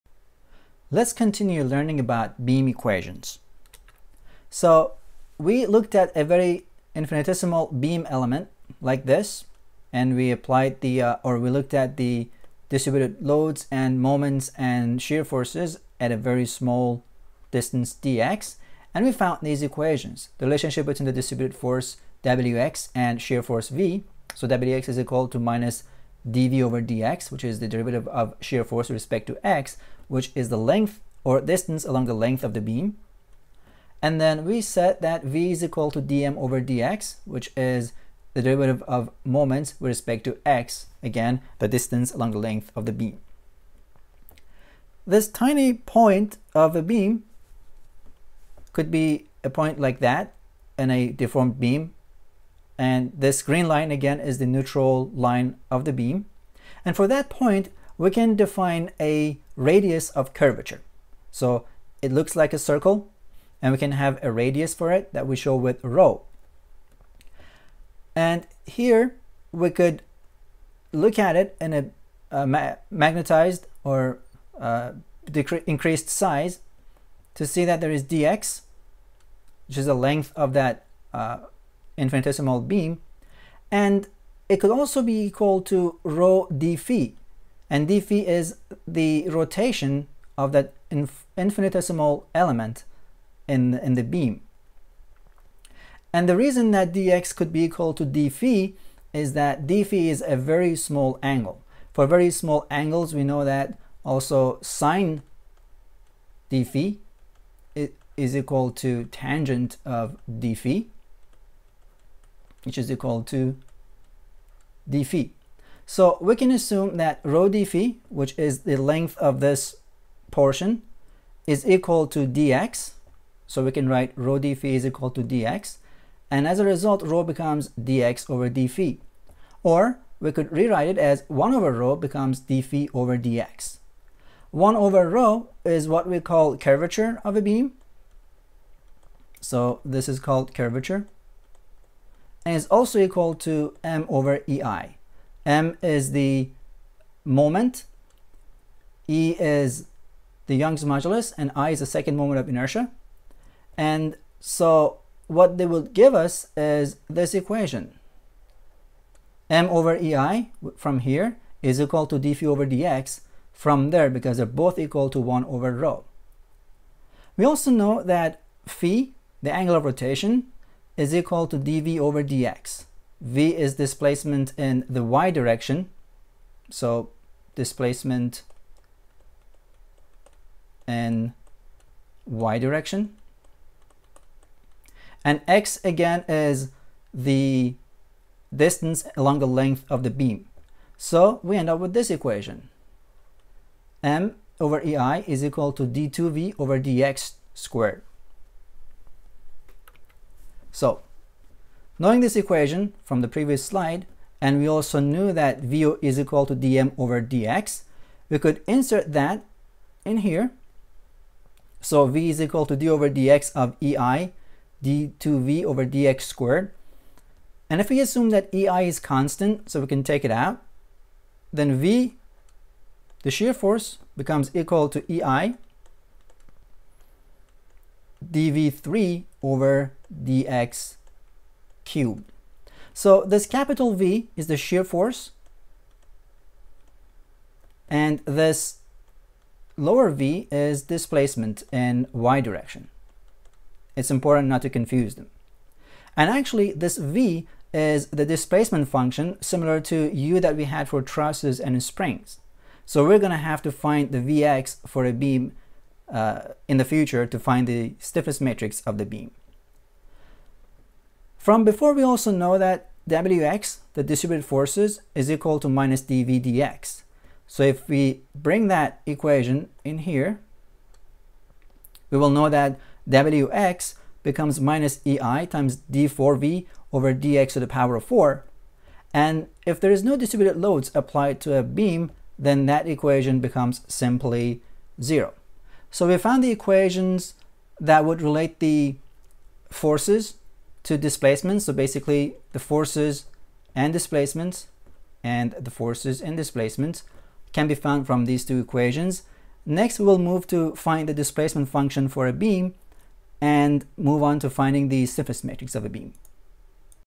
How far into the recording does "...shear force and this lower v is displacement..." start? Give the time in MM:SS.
03:54.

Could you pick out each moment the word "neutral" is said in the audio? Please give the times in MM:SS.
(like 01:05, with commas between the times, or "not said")
00:54.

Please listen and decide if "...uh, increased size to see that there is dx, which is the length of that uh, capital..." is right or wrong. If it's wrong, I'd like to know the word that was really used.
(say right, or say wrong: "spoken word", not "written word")
wrong: "infinitesimal", not "capital".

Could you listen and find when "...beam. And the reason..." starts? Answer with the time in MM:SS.
01:34.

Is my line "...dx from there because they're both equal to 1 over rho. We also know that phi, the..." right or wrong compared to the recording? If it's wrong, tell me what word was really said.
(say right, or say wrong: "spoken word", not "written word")
right.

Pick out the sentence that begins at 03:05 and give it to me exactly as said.
And x again is the distance along the length of the beam.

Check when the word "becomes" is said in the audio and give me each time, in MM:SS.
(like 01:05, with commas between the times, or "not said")
02:07, 02:11, 03:44, 04:34, 04:43.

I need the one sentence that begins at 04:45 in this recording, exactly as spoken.
So we found the equations that would relate the forces to displacements.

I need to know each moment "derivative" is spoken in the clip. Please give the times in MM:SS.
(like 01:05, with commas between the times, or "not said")
00:27, 00:38.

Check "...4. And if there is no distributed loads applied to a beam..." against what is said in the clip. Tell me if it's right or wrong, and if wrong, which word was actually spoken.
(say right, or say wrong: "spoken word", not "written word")
right.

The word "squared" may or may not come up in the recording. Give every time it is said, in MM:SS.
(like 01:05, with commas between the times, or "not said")
03:17, 03:36.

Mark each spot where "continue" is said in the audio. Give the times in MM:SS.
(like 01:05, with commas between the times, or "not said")
00:01.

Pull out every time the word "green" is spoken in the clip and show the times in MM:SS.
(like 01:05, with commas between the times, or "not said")
00:53.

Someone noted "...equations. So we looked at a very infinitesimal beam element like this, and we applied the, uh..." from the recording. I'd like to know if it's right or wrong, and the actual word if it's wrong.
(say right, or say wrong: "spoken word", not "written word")
right.